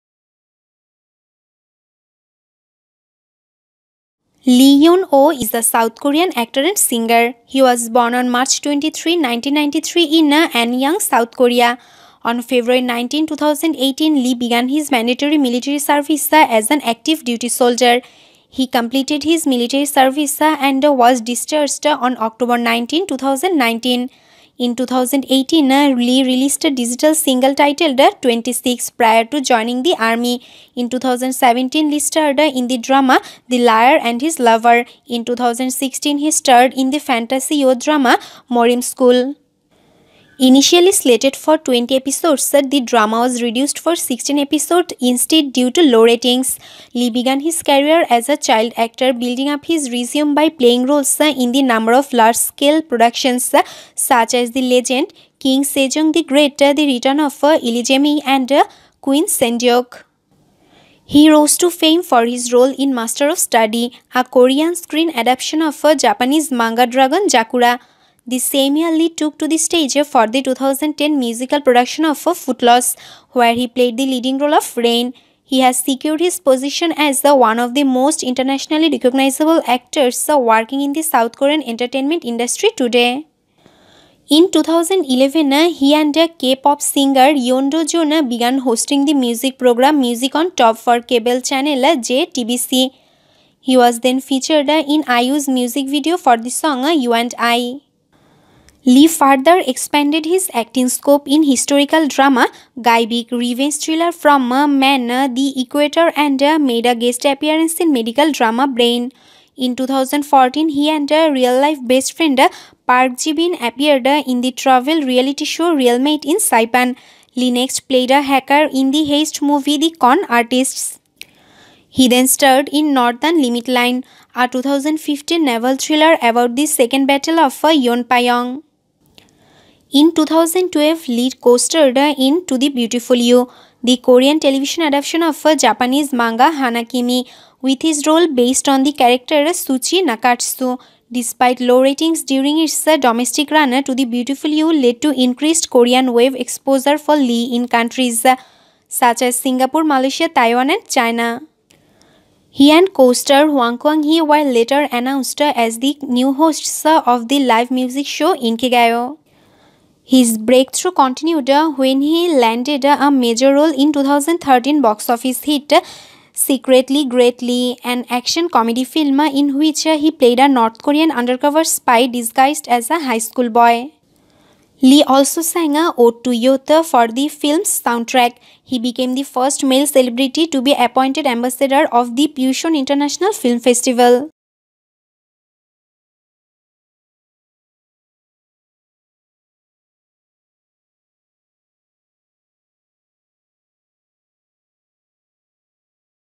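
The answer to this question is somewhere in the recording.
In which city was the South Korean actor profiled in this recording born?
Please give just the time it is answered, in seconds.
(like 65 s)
10 s.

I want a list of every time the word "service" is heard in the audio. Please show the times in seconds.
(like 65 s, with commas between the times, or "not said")
15 s, 19 s.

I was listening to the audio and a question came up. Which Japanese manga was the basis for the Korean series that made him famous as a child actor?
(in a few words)
Dragon Zakura.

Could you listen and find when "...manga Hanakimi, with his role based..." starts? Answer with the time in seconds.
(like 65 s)
136 s.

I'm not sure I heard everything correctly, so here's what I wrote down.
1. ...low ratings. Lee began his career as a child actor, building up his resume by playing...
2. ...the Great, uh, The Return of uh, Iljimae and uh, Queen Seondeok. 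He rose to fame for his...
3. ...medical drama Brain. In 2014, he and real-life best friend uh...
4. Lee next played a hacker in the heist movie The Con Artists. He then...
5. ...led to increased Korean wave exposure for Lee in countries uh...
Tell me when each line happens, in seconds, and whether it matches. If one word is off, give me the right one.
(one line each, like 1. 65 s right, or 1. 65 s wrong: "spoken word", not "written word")
1. 45 s right
2. 56 s right
3. 107 s right
4. 117 s right
5. 144 s right.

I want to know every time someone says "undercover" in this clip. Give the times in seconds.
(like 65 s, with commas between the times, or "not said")
171 s.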